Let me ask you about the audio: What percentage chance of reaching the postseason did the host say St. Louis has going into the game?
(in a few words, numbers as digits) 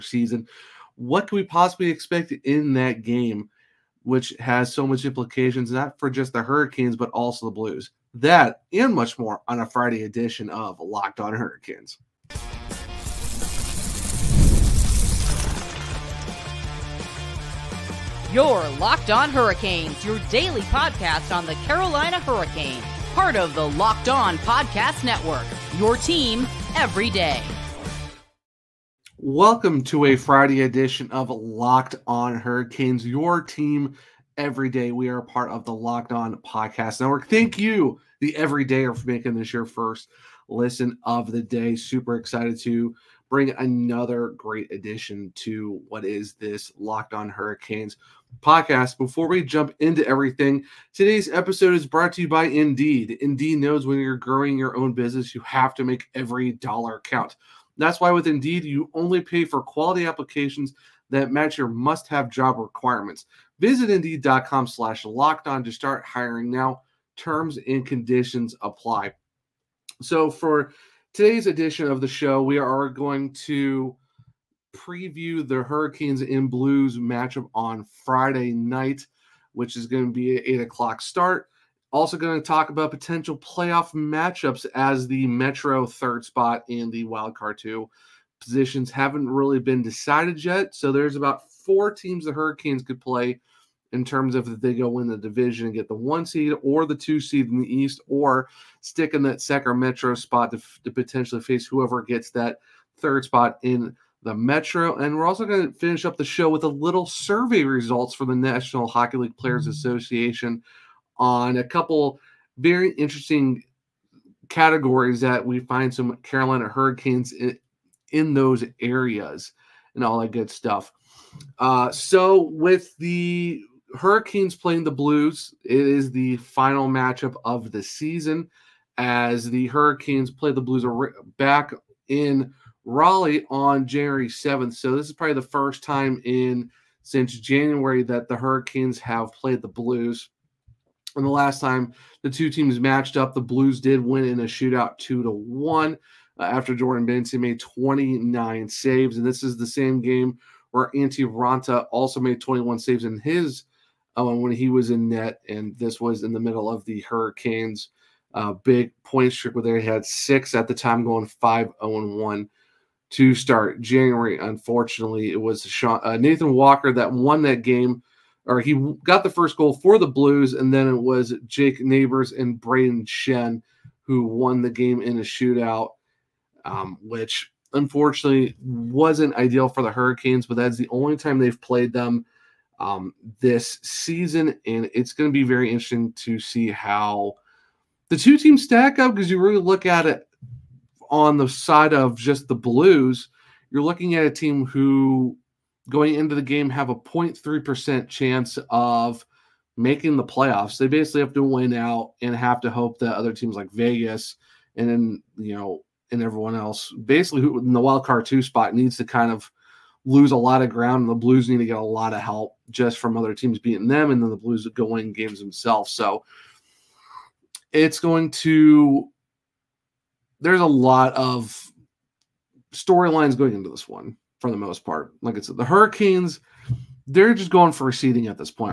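0.3%.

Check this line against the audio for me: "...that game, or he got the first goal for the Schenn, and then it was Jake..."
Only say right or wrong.
wrong.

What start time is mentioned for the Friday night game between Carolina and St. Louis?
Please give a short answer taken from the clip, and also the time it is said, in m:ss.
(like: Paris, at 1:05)
8 o'clock, at 1:20.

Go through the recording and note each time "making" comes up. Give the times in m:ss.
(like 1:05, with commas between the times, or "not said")
0:39, 3:19.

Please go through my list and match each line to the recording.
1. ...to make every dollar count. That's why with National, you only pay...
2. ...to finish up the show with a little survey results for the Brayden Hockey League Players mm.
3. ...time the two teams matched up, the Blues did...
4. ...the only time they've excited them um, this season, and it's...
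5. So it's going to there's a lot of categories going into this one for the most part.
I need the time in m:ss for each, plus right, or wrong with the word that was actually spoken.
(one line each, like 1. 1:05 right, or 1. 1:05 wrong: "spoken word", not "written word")
1. 0:55 wrong: "Indeed", not "National"
2. 1:45 wrong: "National", not "Brayden"
3. 2:21 right
4. 3:00 wrong: "played", not "excited"
5. 3:35 wrong: "storylines", not "categories".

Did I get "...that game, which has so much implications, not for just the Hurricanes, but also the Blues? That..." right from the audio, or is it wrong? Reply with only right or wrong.
right.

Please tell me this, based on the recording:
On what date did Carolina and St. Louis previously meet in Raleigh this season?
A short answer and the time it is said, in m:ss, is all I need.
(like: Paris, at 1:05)
January 7th, at 2:13.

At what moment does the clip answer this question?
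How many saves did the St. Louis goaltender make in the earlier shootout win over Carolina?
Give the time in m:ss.
2:27.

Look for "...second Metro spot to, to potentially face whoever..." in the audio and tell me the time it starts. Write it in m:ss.
1:39.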